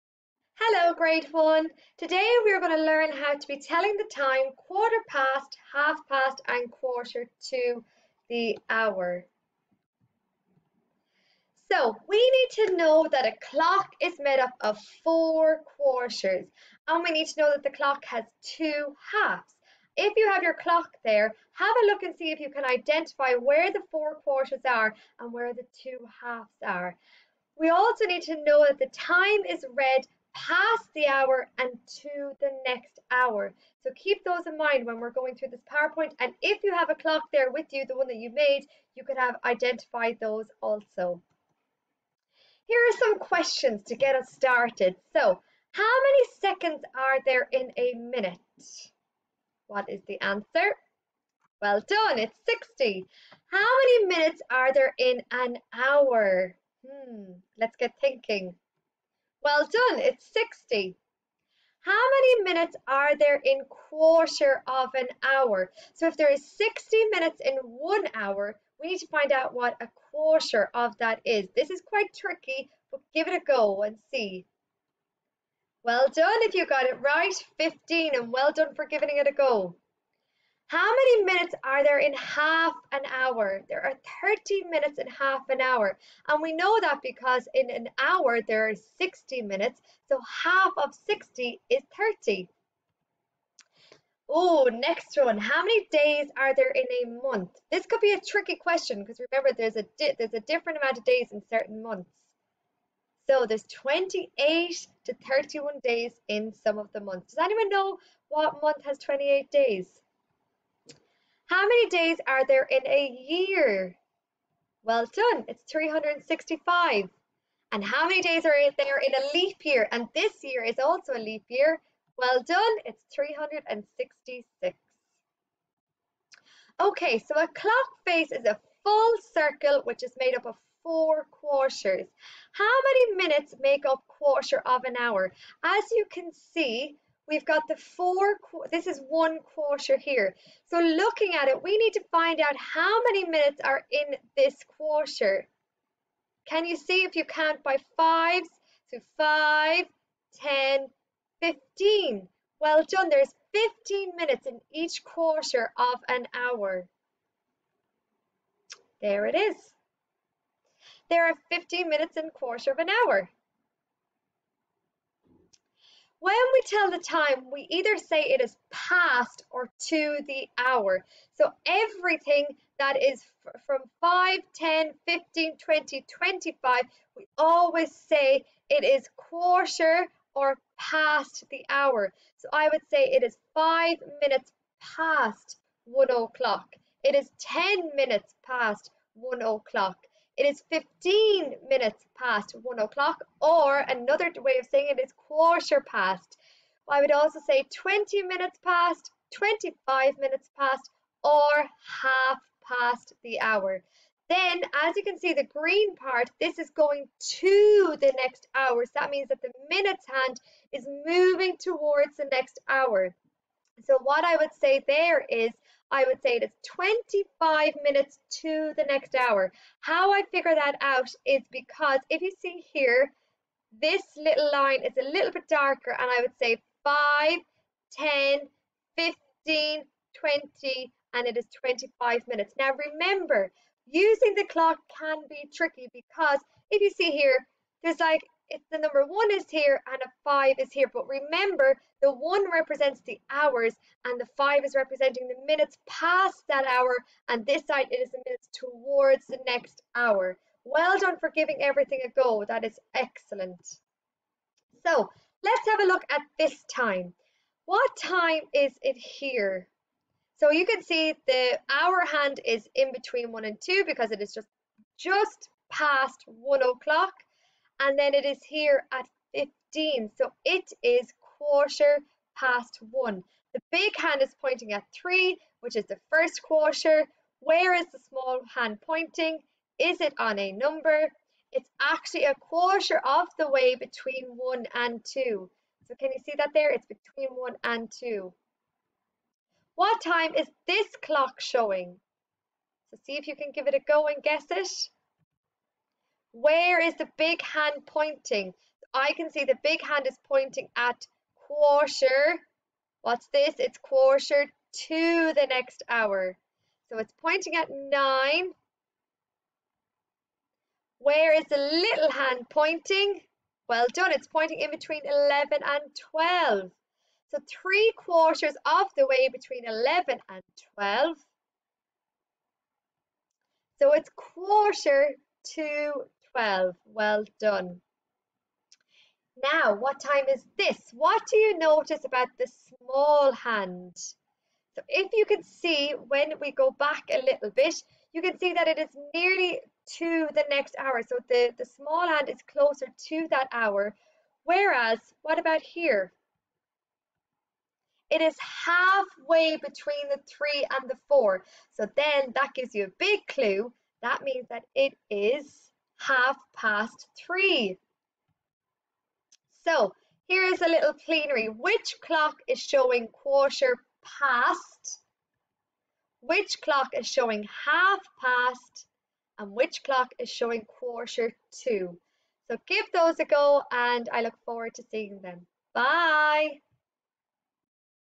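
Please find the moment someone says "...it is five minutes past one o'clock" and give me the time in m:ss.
3:03.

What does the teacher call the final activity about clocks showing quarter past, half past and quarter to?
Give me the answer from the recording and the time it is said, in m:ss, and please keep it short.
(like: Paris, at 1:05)
plenary, at 6:01.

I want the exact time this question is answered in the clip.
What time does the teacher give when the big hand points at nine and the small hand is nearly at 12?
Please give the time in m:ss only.
5:24.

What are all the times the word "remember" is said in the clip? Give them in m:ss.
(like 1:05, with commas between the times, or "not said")
1:39, 3:52, 4:01.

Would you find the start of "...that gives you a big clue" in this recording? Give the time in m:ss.
5:52.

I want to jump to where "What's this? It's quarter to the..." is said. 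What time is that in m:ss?
5:03.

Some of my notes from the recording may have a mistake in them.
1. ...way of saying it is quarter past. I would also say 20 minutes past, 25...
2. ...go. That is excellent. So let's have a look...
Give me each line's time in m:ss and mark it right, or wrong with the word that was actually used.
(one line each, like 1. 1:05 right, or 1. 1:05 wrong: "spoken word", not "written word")
1. 3:14 right
2. 4:12 right.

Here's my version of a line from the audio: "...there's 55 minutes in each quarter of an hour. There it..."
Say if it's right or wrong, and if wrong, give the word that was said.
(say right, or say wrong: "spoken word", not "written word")
wrong: "15", not "55".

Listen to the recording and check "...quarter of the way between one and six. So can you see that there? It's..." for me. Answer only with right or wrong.
wrong.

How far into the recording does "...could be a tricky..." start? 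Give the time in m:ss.
1:37.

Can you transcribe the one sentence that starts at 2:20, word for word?
So looking at it, we need to find out how many minutes are in this quarter.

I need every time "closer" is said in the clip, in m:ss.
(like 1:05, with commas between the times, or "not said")
5:42.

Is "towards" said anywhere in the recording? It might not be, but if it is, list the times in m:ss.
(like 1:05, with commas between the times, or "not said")
3:31, 4:08.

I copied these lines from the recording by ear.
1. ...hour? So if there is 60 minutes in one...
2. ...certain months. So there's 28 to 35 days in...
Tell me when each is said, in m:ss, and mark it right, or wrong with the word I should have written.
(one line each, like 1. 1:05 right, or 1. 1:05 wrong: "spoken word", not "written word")
1. 1:05 right
2. 1:41 wrong: "31", not "35".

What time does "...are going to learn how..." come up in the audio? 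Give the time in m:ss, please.
0:02.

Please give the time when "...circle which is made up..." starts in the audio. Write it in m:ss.
2:09.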